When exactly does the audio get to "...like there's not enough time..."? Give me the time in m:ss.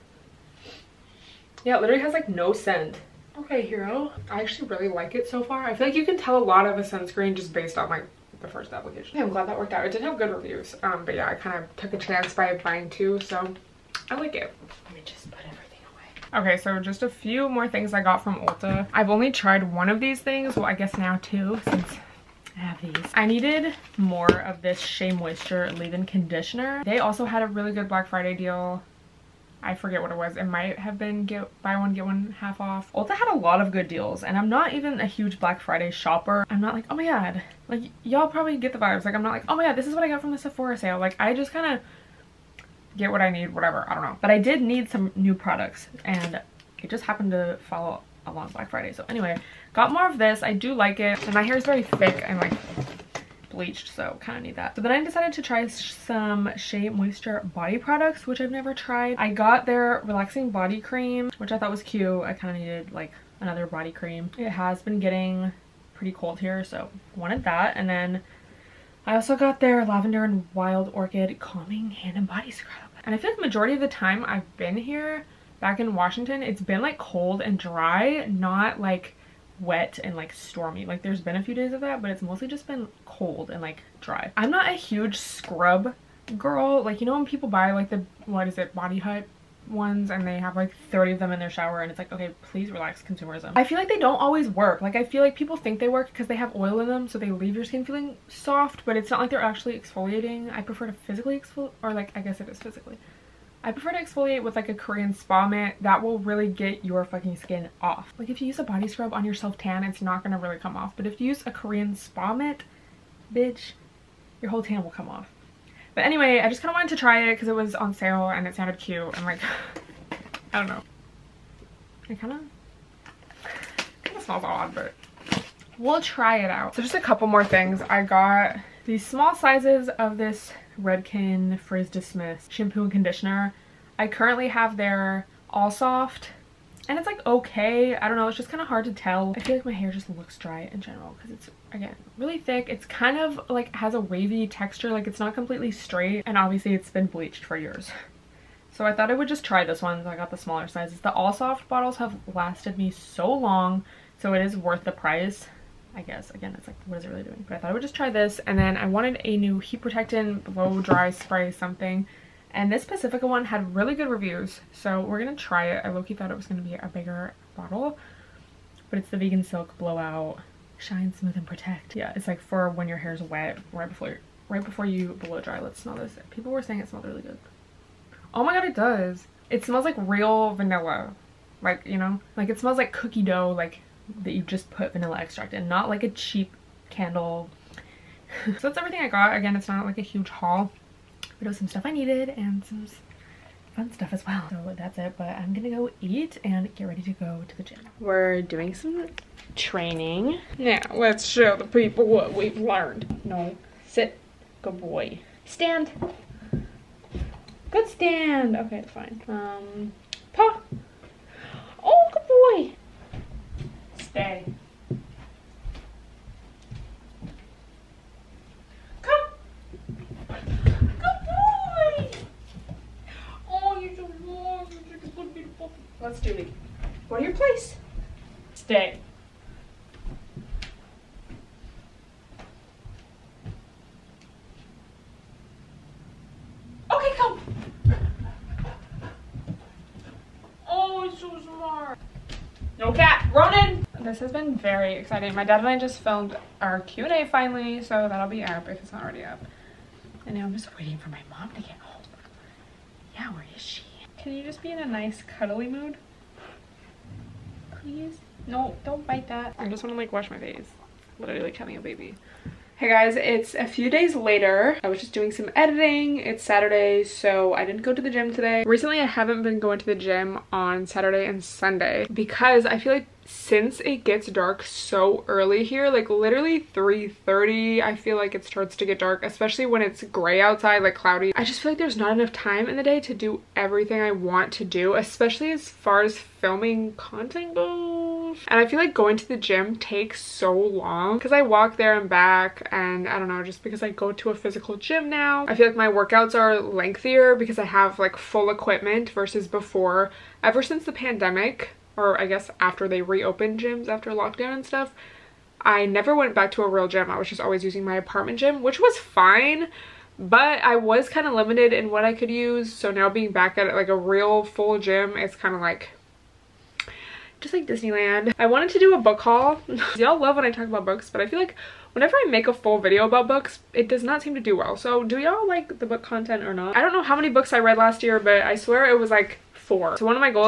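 4:41.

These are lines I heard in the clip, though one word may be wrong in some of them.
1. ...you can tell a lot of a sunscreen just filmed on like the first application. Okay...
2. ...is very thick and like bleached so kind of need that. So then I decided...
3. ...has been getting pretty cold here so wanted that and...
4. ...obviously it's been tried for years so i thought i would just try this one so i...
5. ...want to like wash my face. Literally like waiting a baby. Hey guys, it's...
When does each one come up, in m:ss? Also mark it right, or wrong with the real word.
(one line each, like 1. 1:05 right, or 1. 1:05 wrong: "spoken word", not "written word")
1. 0:05 wrong: "based", not "filmed"
2. 0:51 right
3. 1:04 right
4. 2:26 wrong: "bleached", not "tried"
5. 4:19 wrong: "having", not "waiting".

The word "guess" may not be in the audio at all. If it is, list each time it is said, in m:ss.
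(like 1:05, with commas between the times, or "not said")
0:20, 1:42, 2:36, 5:02.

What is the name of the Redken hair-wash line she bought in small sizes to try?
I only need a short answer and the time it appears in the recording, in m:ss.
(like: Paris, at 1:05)
Frizz Dismiss, at 2:11.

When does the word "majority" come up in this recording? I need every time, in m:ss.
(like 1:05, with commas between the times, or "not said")
1:13.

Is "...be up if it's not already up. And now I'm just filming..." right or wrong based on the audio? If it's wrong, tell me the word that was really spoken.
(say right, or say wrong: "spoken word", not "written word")
wrong: "waiting", not "filming".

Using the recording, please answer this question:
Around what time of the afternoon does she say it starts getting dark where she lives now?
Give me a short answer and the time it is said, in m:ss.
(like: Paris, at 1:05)
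3:30, at 4:36.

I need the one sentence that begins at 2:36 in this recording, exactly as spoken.
Again, it's like, what is it really doing?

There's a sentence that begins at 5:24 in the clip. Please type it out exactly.
So do y'all like the book content or not?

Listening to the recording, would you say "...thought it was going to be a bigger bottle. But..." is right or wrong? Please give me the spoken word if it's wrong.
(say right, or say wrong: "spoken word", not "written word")
right.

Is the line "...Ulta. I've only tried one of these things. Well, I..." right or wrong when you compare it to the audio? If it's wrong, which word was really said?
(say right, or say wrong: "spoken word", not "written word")
right.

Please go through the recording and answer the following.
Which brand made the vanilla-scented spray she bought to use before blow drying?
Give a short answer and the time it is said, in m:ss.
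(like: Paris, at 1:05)
Pacifica, at 2:42.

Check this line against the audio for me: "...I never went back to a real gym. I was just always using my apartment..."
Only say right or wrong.
right.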